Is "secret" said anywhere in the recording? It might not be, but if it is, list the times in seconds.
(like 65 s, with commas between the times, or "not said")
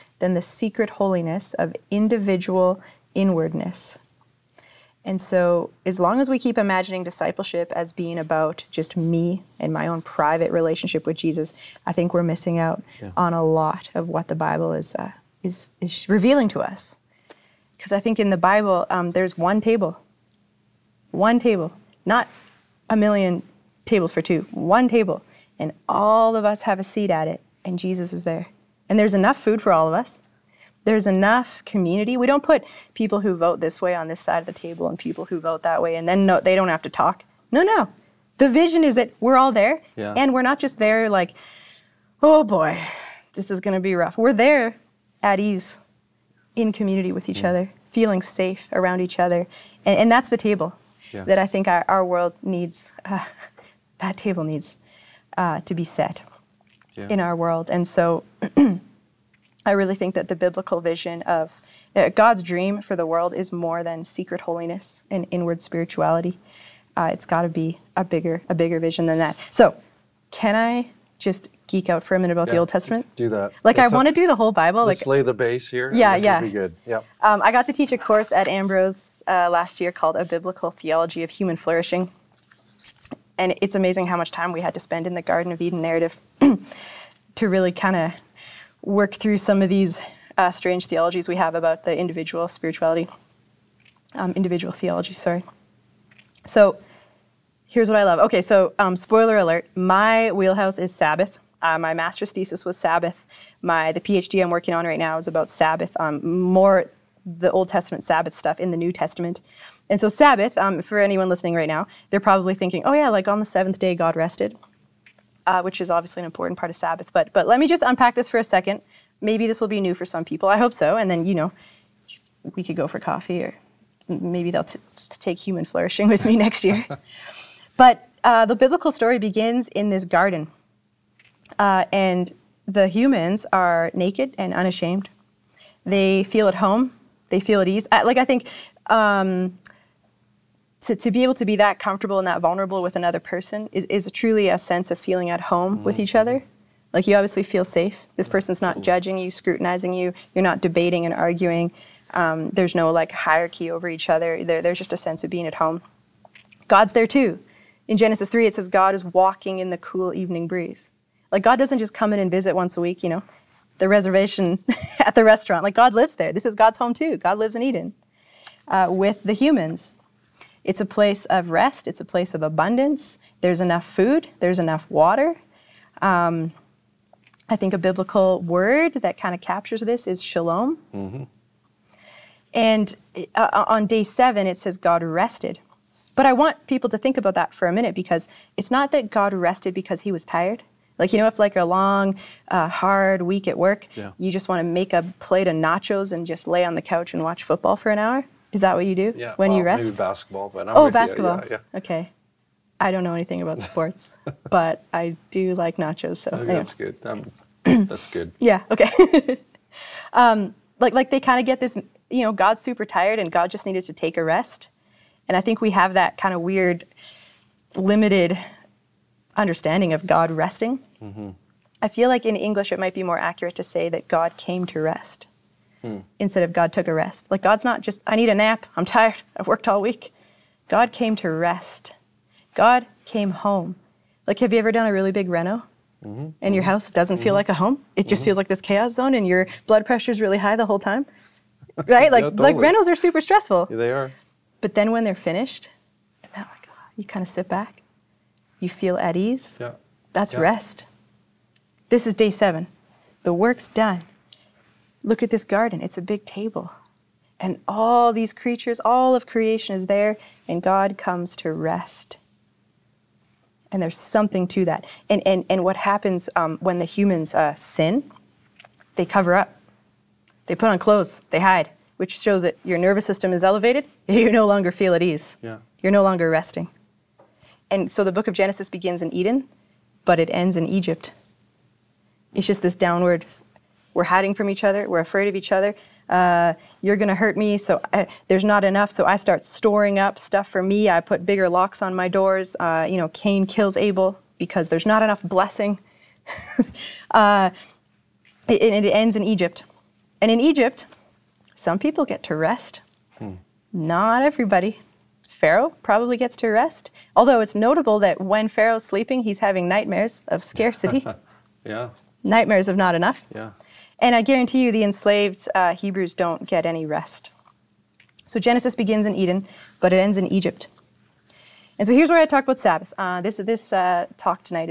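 0 s, 64 s.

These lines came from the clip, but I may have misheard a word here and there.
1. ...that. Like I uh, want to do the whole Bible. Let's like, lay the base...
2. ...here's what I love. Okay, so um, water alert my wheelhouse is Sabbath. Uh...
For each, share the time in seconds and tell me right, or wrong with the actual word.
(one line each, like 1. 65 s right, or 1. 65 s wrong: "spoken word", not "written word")
1. 73 s right
2. 97 s wrong: "spoiler", not "water".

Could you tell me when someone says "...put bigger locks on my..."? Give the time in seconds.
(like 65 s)
290 s.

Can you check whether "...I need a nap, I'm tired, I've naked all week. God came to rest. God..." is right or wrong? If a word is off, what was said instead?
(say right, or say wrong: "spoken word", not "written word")
wrong: "worked", not "naked".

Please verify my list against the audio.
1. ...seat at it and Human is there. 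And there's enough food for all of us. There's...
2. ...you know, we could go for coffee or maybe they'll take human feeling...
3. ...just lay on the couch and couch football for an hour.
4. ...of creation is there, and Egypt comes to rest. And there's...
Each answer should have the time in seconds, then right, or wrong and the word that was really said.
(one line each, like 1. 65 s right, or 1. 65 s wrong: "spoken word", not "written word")
1. 26 s wrong: "Jesus", not "Human"
2. 121 s wrong: "flourishing", not "feeling"
3. 196 s wrong: "watch", not "couch"
4. 259 s wrong: "God", not "Egypt".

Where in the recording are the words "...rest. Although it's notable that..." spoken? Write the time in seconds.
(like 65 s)
306 s.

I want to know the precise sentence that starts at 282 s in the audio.
It's just this downward we're hiding from each other.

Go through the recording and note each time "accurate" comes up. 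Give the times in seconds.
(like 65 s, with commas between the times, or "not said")
223 s.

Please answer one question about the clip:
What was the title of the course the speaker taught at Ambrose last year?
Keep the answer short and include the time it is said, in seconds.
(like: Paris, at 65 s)
A Biblical Theology of Human Flourishing, at 80 s.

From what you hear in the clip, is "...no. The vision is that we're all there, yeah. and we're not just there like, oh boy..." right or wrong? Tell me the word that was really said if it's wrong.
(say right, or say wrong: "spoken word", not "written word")
right.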